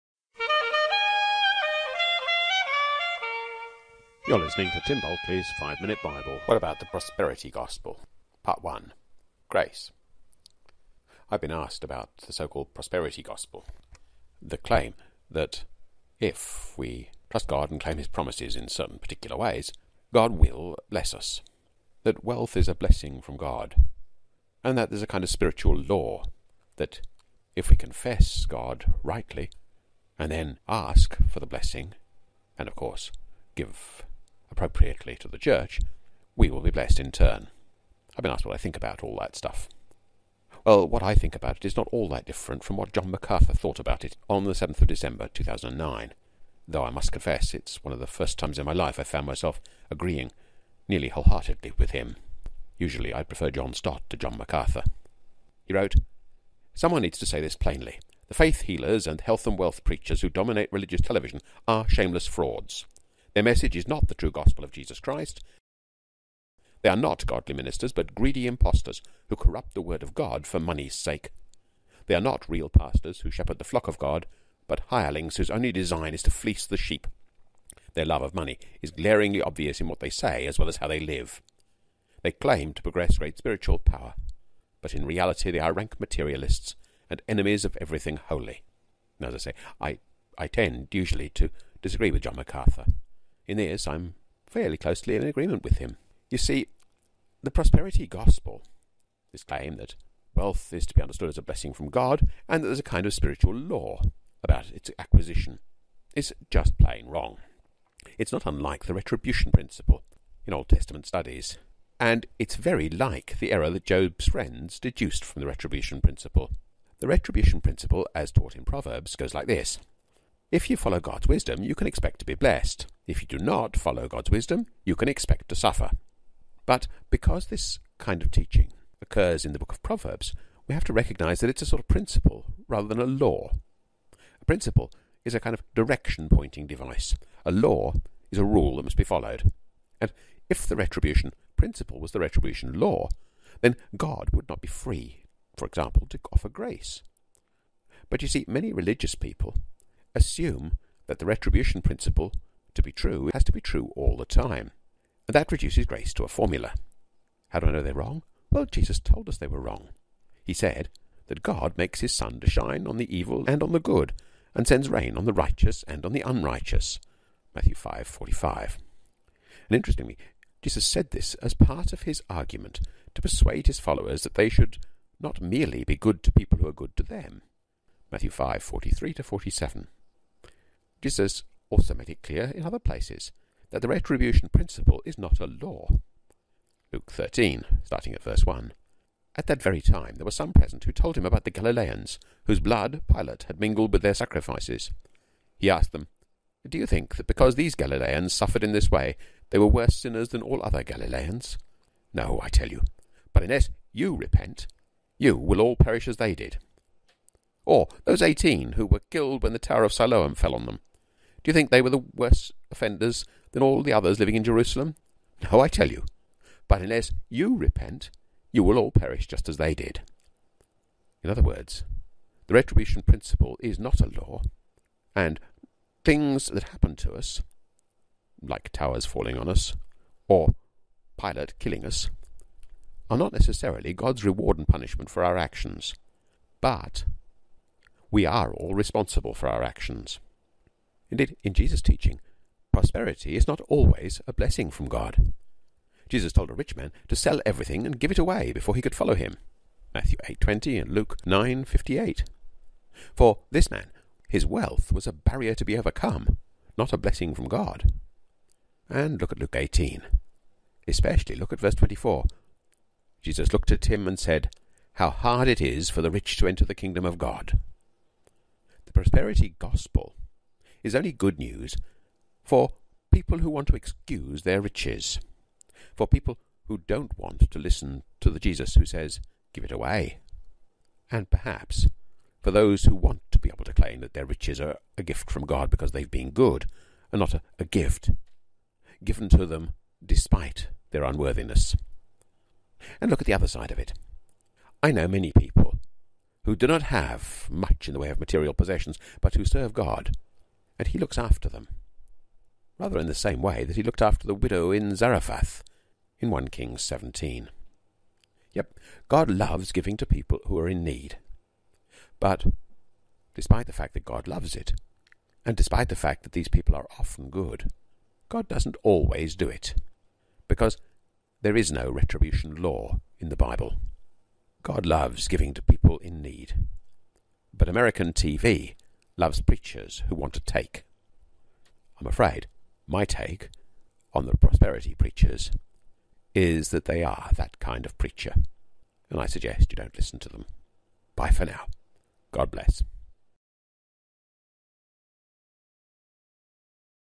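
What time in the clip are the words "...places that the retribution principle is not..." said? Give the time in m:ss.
3:02.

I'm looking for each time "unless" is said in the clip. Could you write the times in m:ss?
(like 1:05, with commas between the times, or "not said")
3:23, 3:36.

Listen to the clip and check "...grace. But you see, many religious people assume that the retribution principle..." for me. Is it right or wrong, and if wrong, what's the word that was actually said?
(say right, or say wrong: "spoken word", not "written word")
right.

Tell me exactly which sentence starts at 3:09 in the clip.
At that very time there were some present who told him about the Galileans, whose blood Pilate had mingled with their sacrifices.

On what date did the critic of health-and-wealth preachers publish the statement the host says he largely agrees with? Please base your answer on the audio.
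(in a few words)
7 December 2009.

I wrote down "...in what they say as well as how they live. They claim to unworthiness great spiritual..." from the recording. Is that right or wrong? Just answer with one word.
wrong.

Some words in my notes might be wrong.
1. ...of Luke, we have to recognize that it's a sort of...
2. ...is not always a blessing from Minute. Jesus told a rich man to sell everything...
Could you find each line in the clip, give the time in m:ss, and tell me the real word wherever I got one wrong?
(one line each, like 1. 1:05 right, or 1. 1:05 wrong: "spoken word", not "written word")
1. 2:09 wrong: "Proverbs", not "Luke"
2. 4:03 wrong: "God", not "Minute".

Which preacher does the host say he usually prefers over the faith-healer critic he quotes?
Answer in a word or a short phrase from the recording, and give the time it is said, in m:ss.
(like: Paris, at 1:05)
John Stott, at 0:53.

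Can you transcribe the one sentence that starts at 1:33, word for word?
In this I am fairly closely in agreement with him.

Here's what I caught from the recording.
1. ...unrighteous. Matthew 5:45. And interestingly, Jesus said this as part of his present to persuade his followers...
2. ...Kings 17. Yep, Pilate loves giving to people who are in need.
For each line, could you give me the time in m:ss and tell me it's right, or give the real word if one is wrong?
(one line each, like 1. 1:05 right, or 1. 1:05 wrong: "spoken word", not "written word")
1. 2:46 wrong: "argument", not "present"
2. 5:06 wrong: "God", not "Pilate".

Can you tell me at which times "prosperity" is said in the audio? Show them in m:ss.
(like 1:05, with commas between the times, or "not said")
0:06, 0:12, 1:37, 4:02, 4:28, 5:34.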